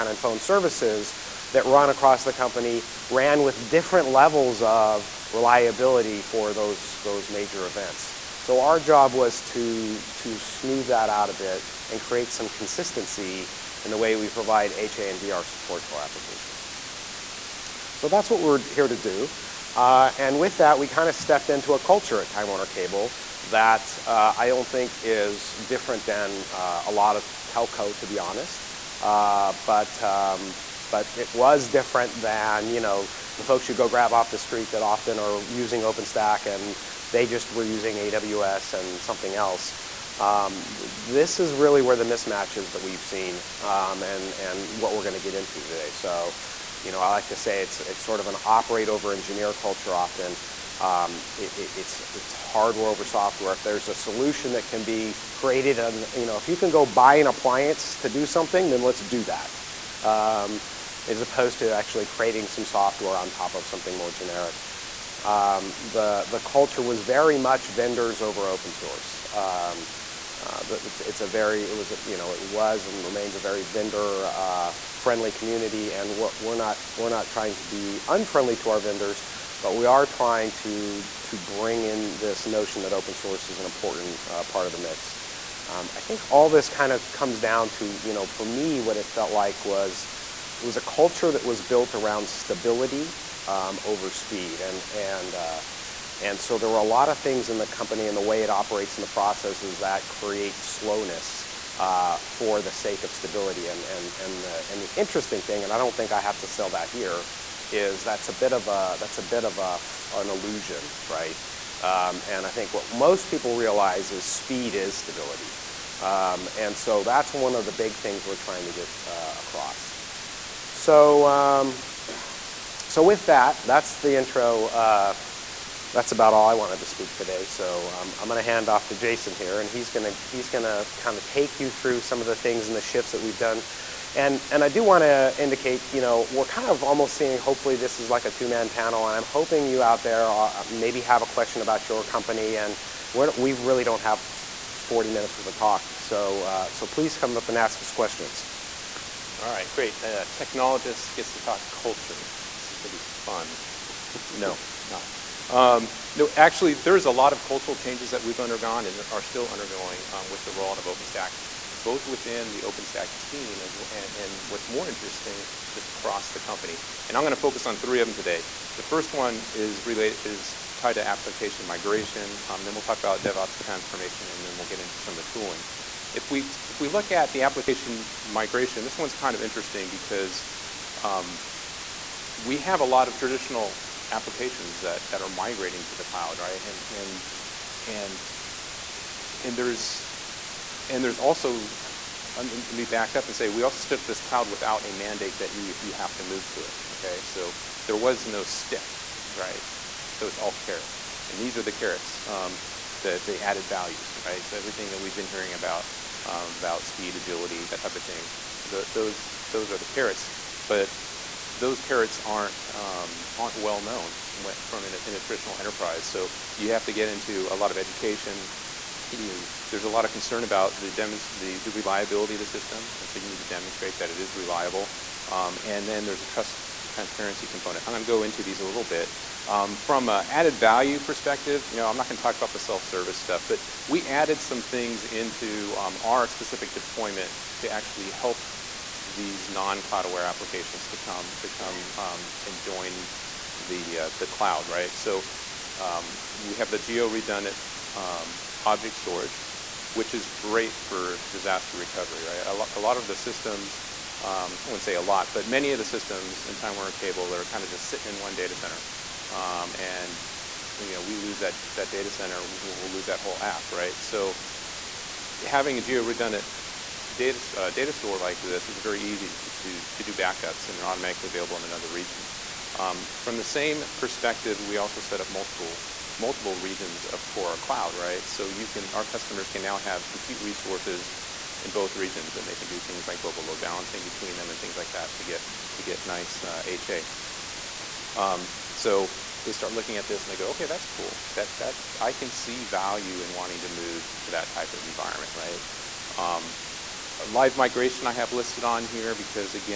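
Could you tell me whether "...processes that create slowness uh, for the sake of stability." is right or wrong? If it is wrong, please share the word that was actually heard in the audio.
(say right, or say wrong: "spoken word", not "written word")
right.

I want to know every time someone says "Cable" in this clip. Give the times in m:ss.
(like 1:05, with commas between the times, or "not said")
0:22, 4:16.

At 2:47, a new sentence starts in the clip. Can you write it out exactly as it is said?
And I'm going to focus on three of them today.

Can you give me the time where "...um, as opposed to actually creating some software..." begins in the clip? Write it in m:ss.
1:00.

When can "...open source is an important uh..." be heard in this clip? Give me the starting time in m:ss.
1:22.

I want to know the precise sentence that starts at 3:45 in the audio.
Um, and then there's a trust transparency component.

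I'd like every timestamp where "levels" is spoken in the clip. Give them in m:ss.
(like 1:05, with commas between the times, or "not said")
0:04.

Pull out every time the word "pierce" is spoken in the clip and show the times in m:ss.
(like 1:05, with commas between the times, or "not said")
not said.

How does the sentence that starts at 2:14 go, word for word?
And and I do want to indicate, you know, we're kind of almost seeing.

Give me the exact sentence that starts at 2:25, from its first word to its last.
So uh, so please come up and ask us questions.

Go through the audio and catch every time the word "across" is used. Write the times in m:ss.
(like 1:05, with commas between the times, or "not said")
0:01, 1:59, 2:45.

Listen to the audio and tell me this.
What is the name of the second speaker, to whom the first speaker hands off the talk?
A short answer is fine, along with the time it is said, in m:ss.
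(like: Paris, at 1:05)
Jason, at 2:08.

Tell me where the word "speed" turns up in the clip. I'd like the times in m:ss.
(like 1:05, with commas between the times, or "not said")
1:34, 1:54, 3:26.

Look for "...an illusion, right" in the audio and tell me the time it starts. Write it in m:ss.
1:50.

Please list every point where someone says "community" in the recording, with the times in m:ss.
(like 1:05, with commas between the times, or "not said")
1:15.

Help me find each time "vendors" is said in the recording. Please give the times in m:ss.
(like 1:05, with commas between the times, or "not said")
1:07, 1:13, 1:18.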